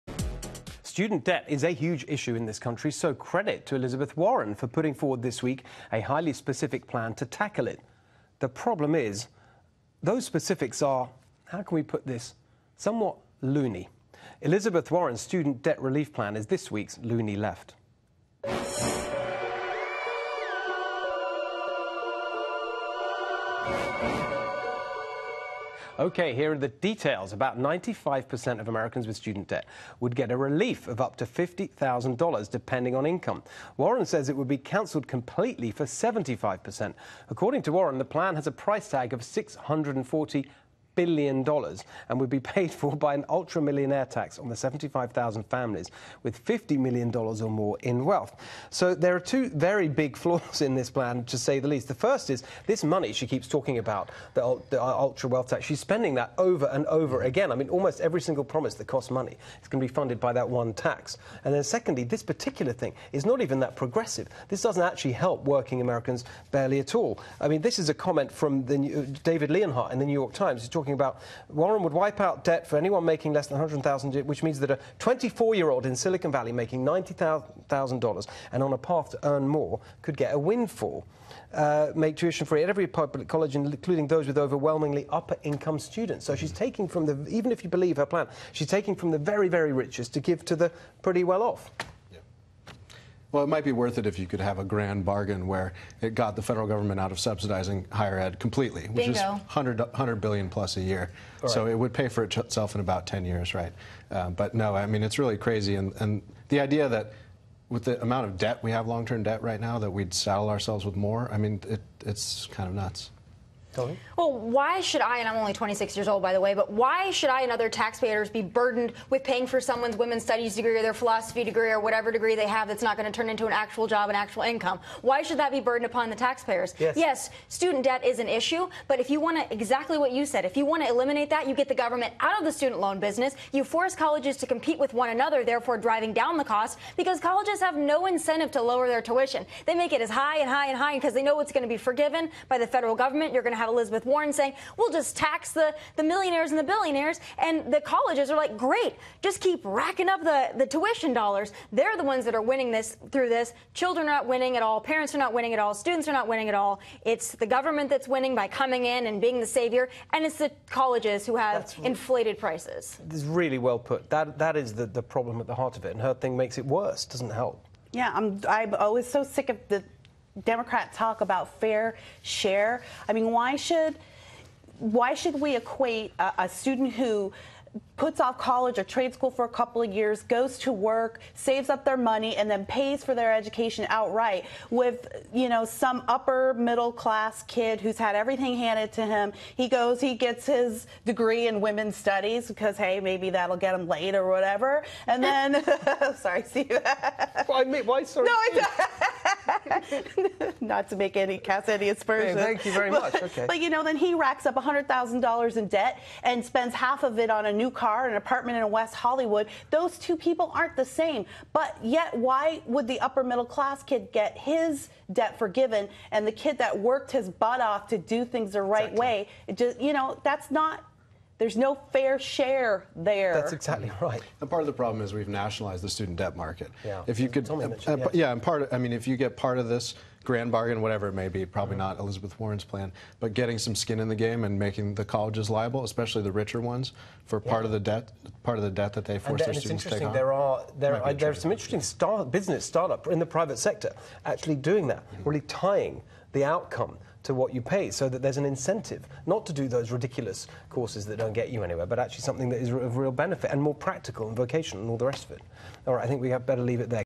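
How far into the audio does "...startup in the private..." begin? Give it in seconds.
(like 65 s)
242 s.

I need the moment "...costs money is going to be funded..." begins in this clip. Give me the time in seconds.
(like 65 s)
58 s.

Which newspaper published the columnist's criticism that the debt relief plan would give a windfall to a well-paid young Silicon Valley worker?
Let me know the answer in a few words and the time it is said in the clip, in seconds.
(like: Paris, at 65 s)
The New York Times, at 70 s.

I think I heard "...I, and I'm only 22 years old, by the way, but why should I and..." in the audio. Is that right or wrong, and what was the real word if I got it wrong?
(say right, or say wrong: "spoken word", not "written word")
wrong: "26", not "22".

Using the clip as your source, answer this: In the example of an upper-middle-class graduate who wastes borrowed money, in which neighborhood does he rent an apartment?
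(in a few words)
West Hollywood.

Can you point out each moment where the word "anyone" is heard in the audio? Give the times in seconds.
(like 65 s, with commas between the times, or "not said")
72 s.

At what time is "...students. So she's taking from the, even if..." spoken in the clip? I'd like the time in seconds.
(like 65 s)
85 s.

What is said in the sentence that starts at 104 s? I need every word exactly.
Uh, but no, I mean, it's really crazy.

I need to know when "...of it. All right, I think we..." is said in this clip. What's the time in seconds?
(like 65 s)
255 s.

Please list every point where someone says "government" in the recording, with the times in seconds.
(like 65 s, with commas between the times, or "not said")
96 s, 131 s, 142 s, 157 s.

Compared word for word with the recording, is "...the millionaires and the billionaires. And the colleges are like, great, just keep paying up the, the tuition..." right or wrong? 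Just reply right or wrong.
wrong.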